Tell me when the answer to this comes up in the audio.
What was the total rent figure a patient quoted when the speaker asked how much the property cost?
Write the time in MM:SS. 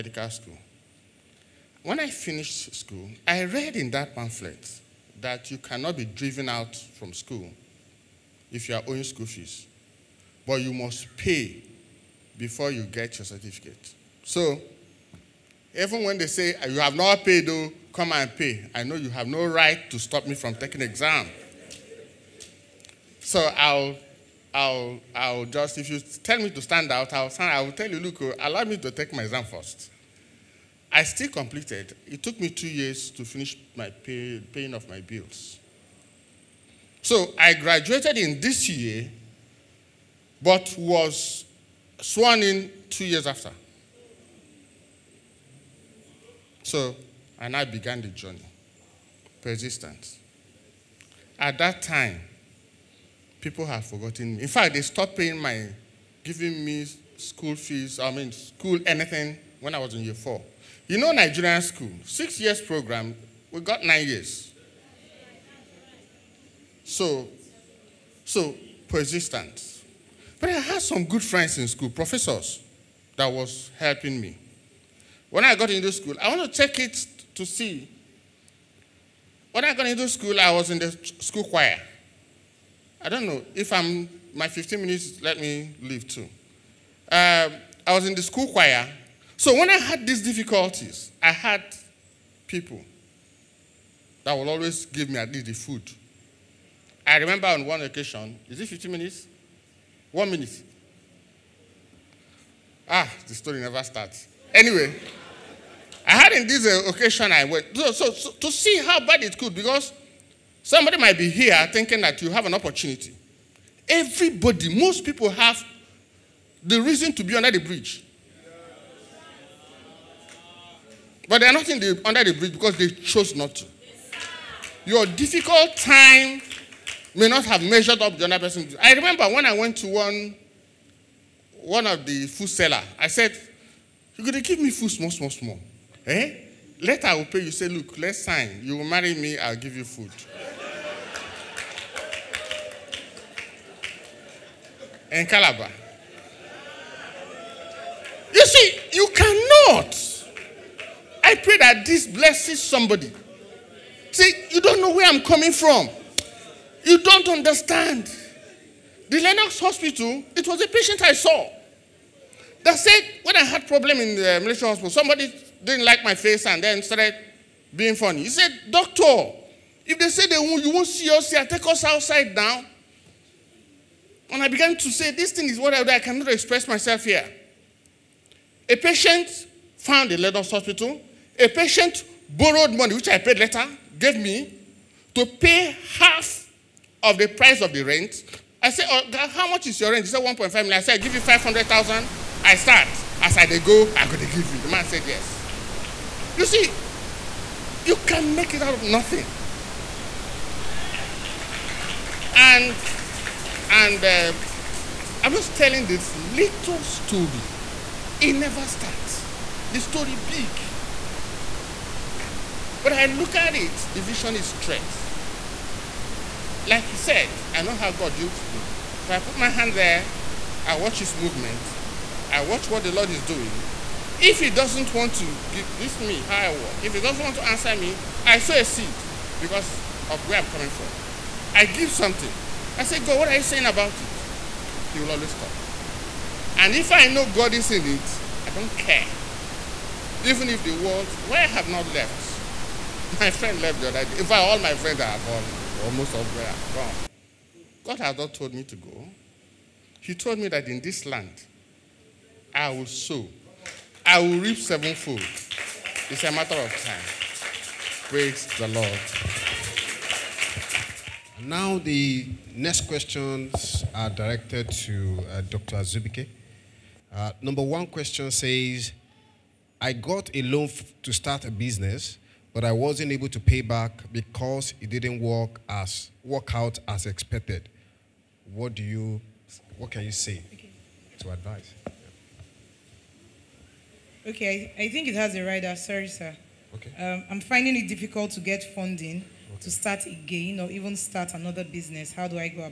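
03:10.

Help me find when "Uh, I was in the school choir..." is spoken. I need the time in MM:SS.
01:27.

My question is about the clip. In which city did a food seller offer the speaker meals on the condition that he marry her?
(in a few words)
Calabar.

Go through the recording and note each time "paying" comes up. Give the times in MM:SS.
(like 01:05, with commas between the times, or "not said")
00:34, 00:55.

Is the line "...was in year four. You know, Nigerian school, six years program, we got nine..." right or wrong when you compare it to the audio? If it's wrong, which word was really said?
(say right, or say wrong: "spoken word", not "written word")
right.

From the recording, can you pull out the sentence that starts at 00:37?
So I graduated in this year but was sworn in two years after.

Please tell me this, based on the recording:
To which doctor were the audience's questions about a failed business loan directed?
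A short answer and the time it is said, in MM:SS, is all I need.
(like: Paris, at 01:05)
Dr. Azubuike, at 04:25.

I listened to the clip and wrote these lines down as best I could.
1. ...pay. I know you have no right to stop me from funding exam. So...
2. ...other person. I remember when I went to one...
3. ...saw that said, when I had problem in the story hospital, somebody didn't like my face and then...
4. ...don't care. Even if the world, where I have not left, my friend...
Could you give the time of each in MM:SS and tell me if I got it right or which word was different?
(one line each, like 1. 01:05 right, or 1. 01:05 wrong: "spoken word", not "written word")
1. 00:18 wrong: "taking", not "funding"
2. 02:08 right
3. 02:41 wrong: "military", not "story"
4. 03:58 right.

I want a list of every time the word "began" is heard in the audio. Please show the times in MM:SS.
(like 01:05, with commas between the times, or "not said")
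00:47, 02:54.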